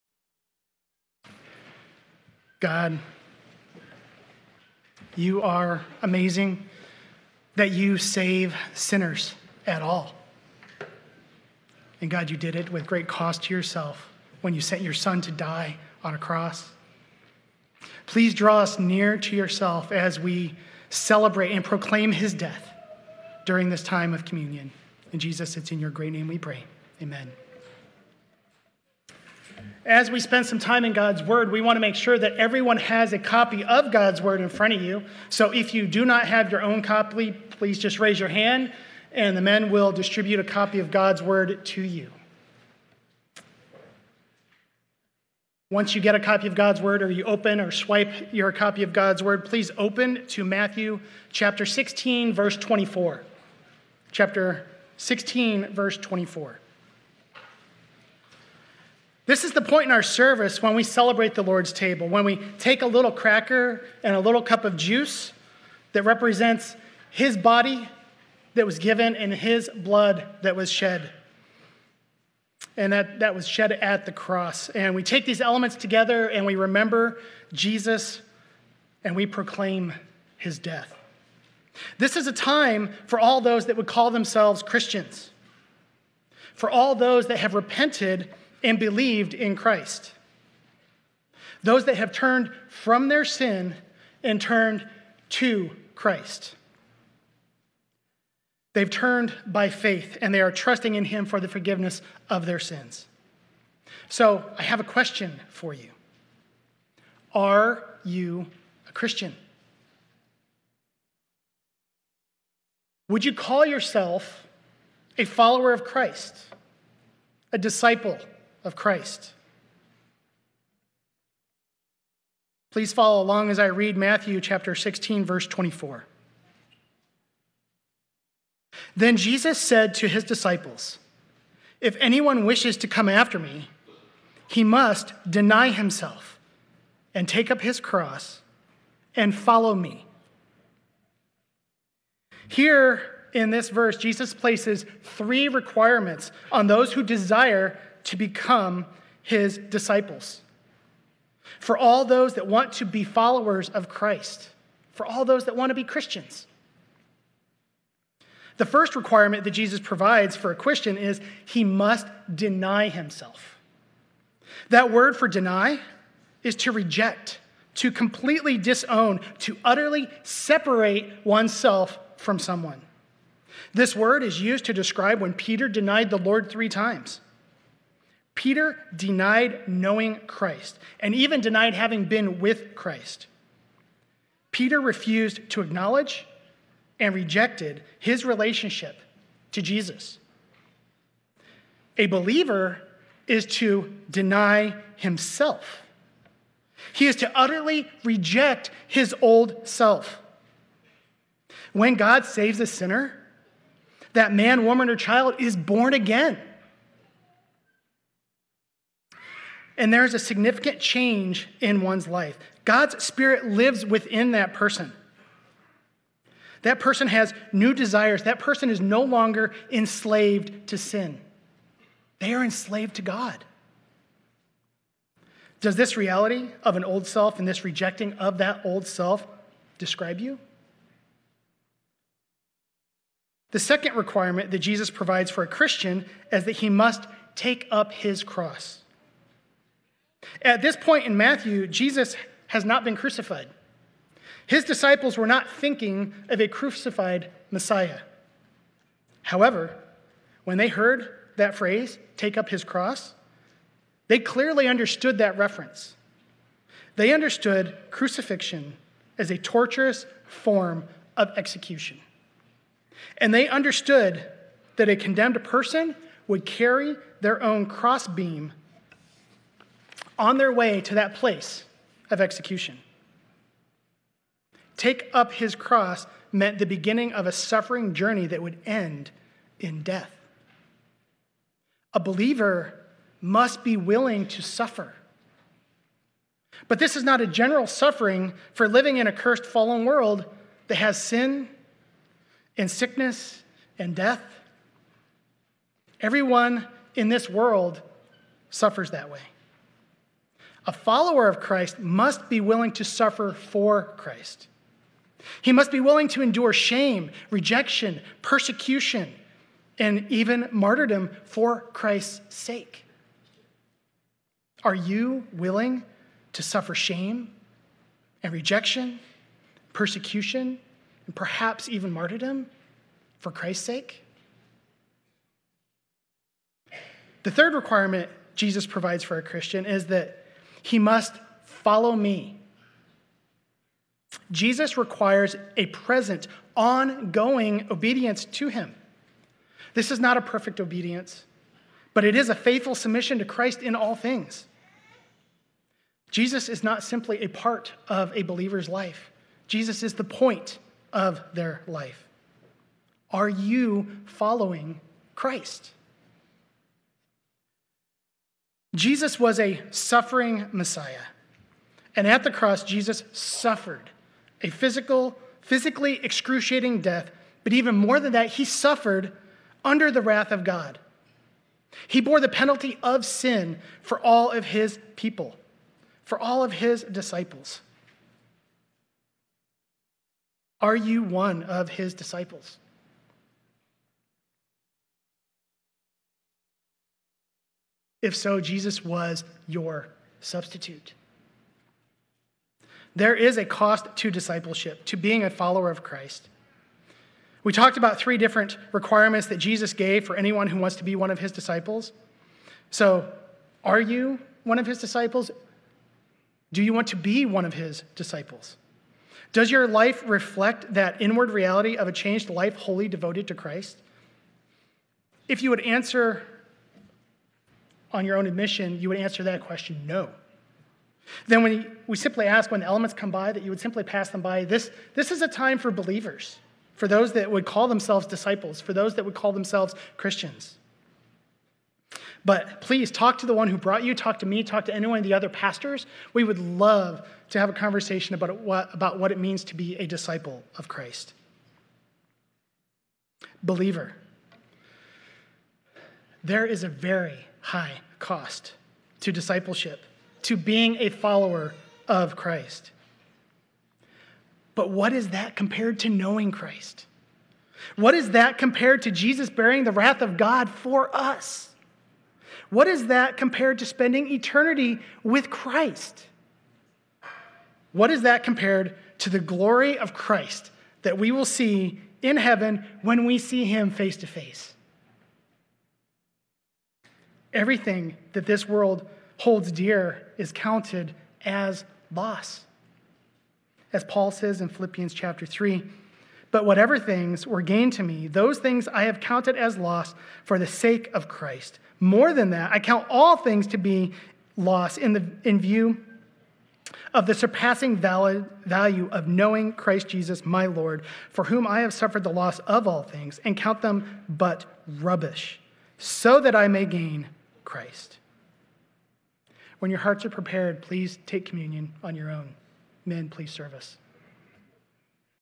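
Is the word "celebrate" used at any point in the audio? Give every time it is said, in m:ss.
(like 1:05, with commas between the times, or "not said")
0:20, 1:00.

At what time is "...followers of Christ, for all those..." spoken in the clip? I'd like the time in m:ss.
2:33.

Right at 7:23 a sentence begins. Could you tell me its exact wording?
Believer, there is a very high cost to discipleship, to being a follower of Christ.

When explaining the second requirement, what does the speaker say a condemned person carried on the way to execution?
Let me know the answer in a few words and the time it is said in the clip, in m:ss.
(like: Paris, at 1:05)
Their own crossbeam, at 4:27.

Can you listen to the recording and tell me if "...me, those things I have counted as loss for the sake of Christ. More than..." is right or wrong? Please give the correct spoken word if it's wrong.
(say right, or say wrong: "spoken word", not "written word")
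right.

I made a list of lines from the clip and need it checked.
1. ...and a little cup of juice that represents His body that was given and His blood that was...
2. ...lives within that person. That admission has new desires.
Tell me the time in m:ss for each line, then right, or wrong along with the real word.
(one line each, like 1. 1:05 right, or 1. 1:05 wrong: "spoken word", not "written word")
1. 1:04 right
2. 3:33 wrong: "person", not "admission".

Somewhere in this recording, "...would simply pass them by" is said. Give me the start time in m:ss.
7:03.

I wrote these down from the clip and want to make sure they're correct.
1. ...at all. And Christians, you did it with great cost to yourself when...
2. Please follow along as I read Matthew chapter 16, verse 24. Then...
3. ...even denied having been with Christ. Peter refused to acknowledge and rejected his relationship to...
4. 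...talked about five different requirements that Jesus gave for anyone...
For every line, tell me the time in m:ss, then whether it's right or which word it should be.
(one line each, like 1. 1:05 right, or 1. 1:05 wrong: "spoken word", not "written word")
1. 0:09 wrong: "God", not "Christians"
2. 2:02 right
3. 3:01 right
4. 6:37 wrong: "three", not "five".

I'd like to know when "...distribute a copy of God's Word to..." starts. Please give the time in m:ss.
0:39.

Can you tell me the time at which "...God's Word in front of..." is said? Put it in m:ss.
0:33.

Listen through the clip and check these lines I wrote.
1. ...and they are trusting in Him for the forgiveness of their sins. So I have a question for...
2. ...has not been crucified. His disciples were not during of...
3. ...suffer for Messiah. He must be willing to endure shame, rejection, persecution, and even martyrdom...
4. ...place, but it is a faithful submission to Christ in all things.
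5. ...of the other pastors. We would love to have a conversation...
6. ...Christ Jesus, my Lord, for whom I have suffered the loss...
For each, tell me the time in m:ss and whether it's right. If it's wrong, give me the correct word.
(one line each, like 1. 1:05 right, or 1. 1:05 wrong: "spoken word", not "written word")
1. 1:40 right
2. 4:02 wrong: "thinking", not "during"
3. 5:02 wrong: "Christ", not "Messiah"
4. 5:40 wrong: "obedience", not "place"
5. 7:14 right
6. 8:19 right.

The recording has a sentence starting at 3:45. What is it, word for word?
Does this reality of an old self and this rejecting of that old self describe you?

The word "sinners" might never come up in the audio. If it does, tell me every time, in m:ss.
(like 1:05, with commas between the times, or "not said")
0:08, 3:22.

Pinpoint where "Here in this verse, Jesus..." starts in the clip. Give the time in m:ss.
2:22.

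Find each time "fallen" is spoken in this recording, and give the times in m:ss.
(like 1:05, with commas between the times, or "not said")
4:49.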